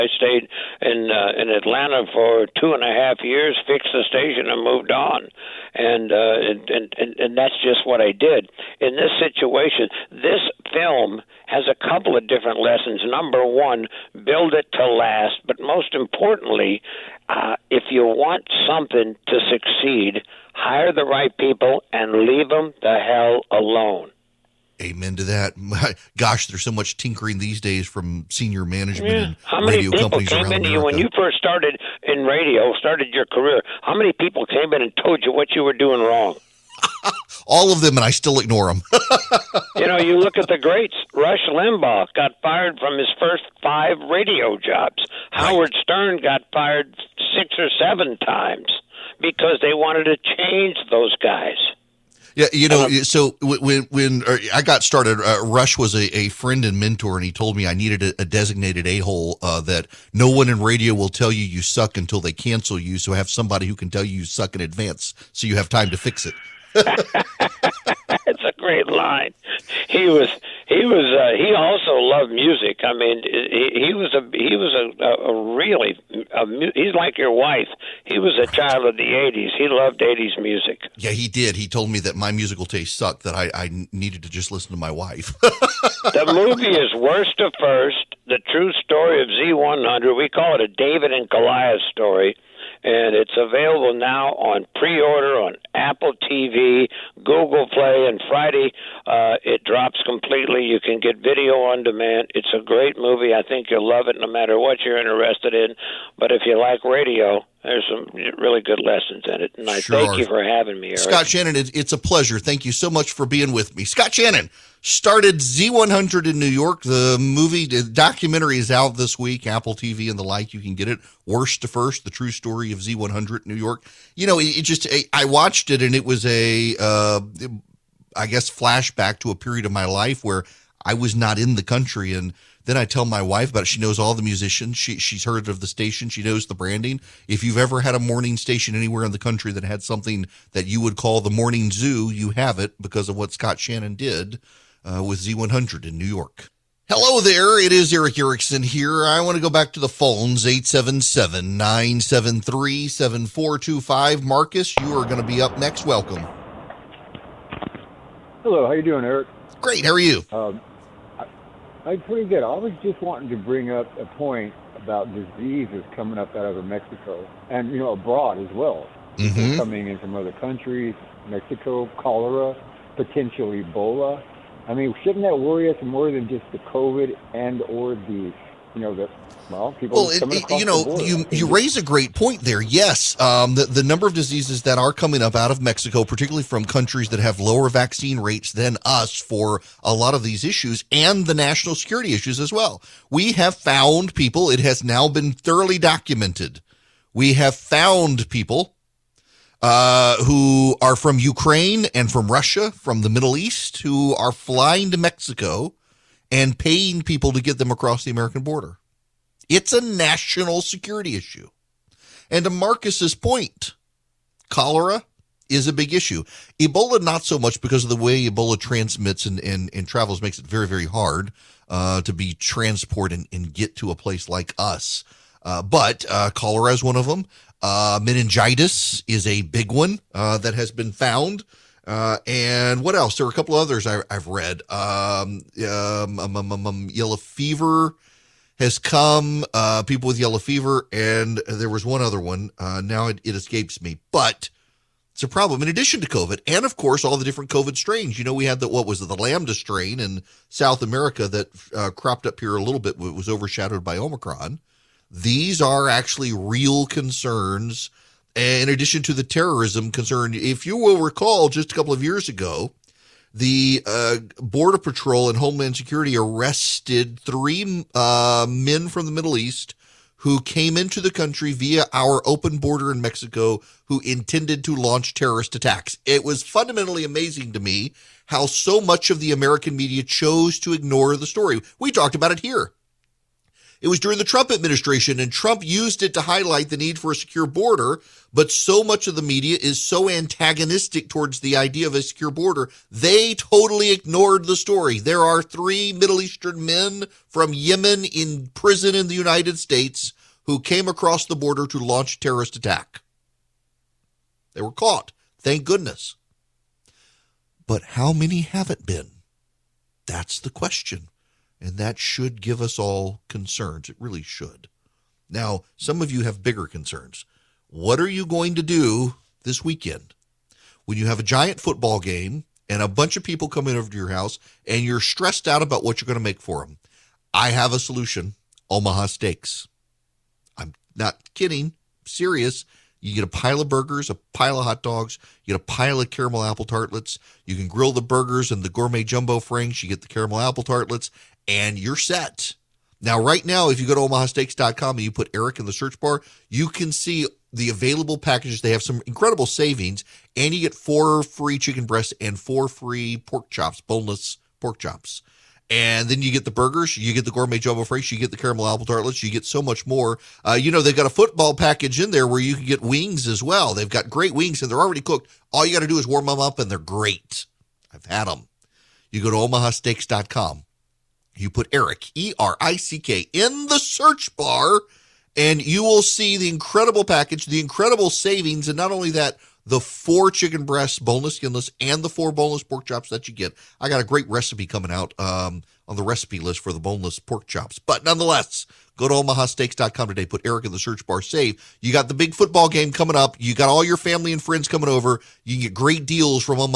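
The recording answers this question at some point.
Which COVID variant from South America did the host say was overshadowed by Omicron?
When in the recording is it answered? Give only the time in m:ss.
4:09.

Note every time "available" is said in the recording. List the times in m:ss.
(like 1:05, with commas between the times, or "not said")
1:33, 5:47.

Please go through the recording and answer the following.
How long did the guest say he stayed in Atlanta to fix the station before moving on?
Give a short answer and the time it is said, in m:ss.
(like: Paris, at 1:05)
2.5 years, at 0:02.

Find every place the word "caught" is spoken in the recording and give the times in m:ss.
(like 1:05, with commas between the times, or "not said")
5:04.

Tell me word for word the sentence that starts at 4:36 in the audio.
It was fundamentally amazing to me how so much of the American media chose to ignore the story.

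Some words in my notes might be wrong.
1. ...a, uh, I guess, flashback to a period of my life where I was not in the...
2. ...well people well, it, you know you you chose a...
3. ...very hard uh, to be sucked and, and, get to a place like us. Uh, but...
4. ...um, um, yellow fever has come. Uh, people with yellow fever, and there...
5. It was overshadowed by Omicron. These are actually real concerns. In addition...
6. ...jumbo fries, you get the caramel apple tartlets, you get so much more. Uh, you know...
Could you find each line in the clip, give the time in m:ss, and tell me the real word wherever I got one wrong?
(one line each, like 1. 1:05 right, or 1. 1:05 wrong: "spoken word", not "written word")
1. 2:06 right
2. 2:59 wrong: "raise", not "chose"
3. 3:40 wrong: "transported", not "sucked"
4. 3:56 right
5. 4:12 right
6. 5:57 right.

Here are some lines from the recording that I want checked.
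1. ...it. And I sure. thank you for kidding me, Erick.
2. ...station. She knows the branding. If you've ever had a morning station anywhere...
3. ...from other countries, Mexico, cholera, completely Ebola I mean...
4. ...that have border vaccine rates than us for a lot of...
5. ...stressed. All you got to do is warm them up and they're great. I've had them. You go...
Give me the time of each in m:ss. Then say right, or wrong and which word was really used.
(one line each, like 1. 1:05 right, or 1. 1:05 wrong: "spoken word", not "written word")
1. 1:49 wrong: "having", not "kidding"
2. 2:15 right
3. 2:49 wrong: "potentially", not "completely"
4. 3:07 wrong: "lower", not "border"
5. 6:04 wrong: "cooked", not "stressed".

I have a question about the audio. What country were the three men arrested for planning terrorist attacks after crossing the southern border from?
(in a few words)
Yemen.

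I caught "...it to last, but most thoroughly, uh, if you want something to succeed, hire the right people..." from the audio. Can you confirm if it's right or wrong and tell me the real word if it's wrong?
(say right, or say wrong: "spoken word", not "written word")
wrong: "importantly", not "thoroughly".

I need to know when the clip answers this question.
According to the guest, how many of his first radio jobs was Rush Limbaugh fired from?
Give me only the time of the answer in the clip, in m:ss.
0:43.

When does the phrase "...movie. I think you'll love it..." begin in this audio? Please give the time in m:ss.
1:42.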